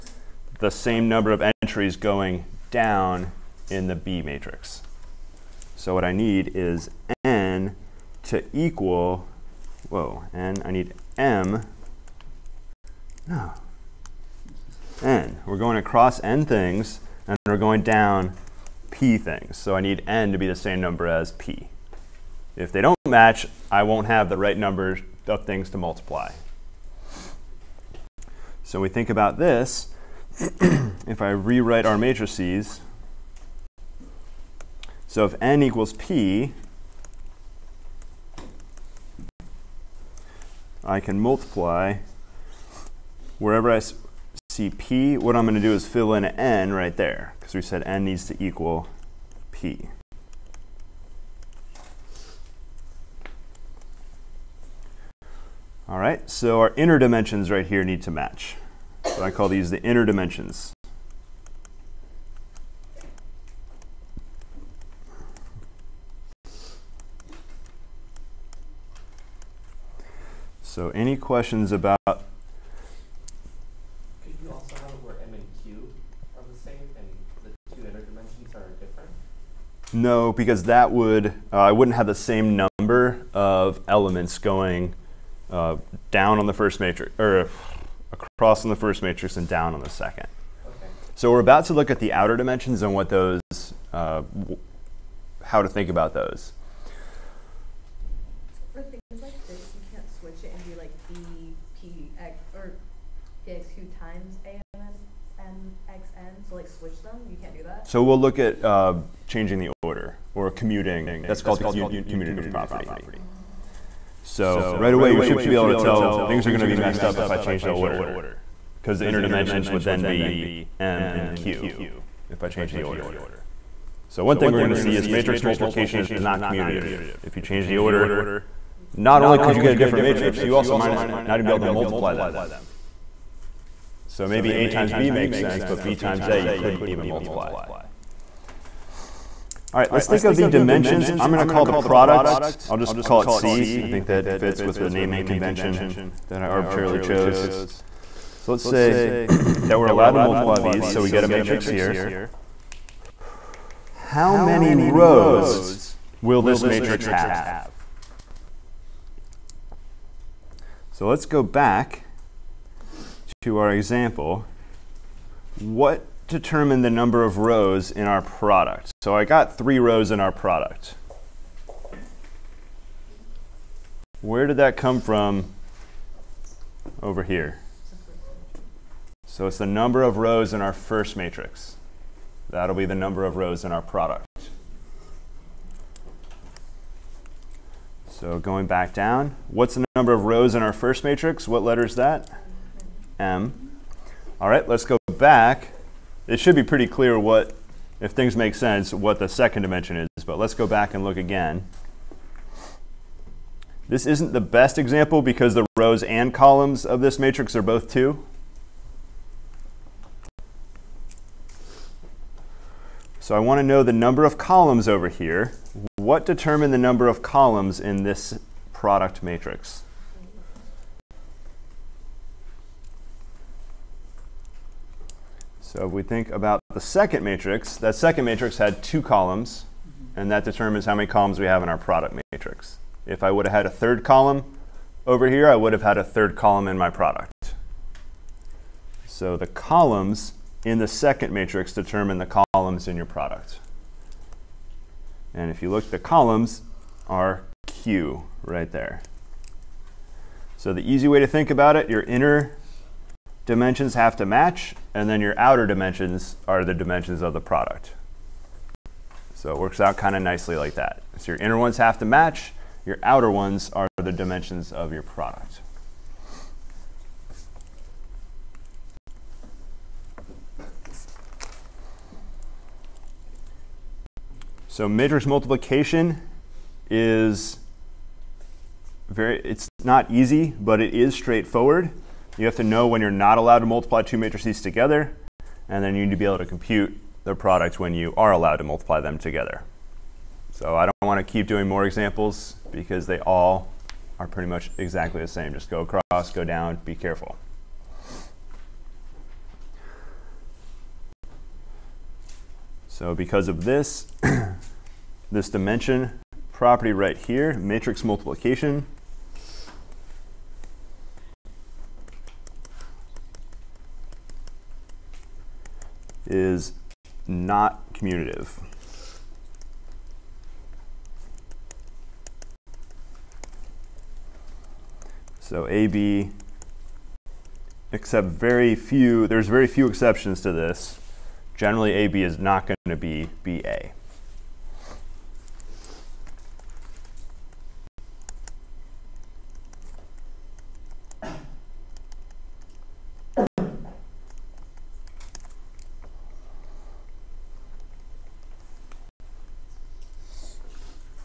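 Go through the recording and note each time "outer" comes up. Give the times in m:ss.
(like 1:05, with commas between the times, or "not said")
1:32, 4:15, 4:23.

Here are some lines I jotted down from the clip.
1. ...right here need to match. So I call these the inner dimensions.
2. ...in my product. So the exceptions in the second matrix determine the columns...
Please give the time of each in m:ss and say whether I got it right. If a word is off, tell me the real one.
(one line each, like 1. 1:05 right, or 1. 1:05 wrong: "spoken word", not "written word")
1. 0:57 right
2. 3:56 wrong: "columns", not "exceptions".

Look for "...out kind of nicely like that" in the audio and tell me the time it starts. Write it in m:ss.
4:19.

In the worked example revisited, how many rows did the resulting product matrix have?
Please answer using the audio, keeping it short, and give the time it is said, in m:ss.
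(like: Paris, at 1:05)
3, at 2:49.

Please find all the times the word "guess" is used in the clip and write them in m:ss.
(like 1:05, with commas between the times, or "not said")
not said.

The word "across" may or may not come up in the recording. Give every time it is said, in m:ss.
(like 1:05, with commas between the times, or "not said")
0:15, 1:28, 4:55.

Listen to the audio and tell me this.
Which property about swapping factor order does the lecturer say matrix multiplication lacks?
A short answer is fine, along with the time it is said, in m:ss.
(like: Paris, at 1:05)
commutative property, at 1:51.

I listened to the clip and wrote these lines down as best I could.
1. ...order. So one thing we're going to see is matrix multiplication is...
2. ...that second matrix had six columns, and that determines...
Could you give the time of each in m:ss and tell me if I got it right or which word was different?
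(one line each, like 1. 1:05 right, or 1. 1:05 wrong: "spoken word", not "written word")
1. 2:02 right
2. 3:47 wrong: "two", not "six".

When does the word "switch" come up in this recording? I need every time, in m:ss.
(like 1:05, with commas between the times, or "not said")
1:40, 1:46.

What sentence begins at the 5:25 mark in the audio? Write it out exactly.
So AB, except very few, there's very few exceptions to this.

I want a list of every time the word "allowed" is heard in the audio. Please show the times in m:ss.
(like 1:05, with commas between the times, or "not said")
2:29, 4:43, 4:48.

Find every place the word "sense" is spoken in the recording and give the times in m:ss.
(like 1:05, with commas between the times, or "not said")
2:15, 3:18.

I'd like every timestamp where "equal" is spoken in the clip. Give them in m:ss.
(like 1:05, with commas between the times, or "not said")
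0:08, 0:35, 0:48.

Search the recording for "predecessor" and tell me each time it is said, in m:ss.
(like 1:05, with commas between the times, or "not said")
not said.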